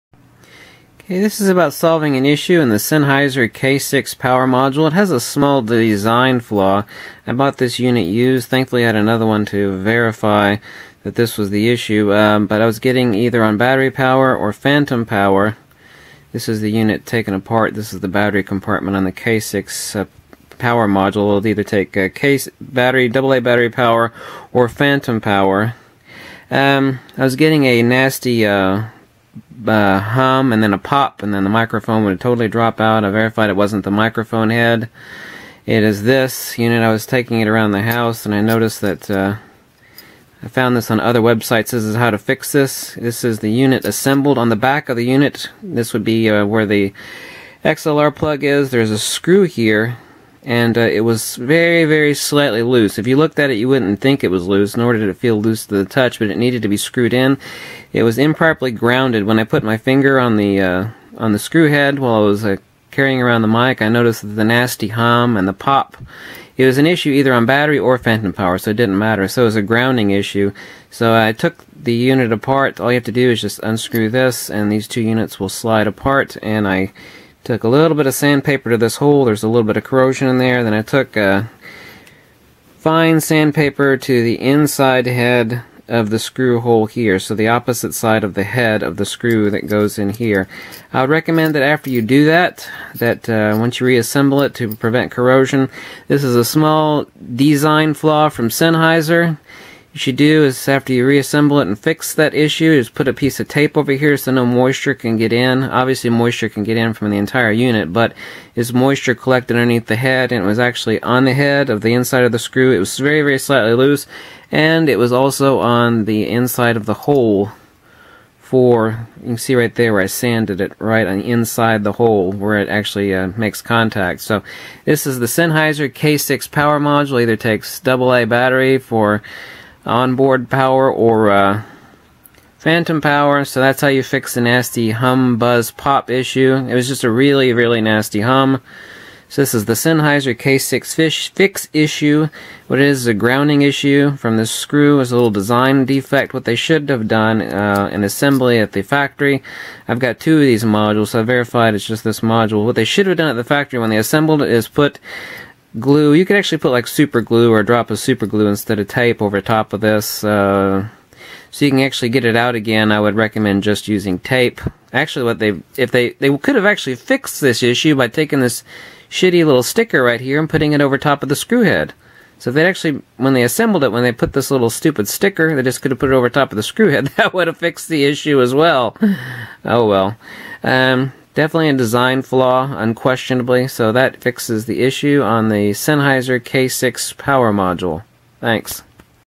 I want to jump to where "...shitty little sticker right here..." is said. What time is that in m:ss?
2:49.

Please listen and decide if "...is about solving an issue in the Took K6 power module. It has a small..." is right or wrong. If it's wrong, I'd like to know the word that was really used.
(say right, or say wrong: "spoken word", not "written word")
wrong: "Sennheiser", not "Took".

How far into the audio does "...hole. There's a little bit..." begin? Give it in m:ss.
1:18.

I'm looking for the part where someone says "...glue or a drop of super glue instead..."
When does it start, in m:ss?
2:37.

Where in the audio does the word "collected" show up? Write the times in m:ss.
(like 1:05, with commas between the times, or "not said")
1:49.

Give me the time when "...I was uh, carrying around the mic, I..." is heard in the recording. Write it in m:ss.
1:02.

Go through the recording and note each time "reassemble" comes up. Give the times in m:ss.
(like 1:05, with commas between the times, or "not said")
1:33, 1:41.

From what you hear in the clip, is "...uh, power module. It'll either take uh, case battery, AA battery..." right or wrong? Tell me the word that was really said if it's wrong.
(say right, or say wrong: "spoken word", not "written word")
right.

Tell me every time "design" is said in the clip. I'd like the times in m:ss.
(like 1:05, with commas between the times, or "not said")
0:05, 1:37, 2:25, 3:01.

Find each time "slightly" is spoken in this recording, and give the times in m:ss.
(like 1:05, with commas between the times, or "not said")
0:52, 1:53.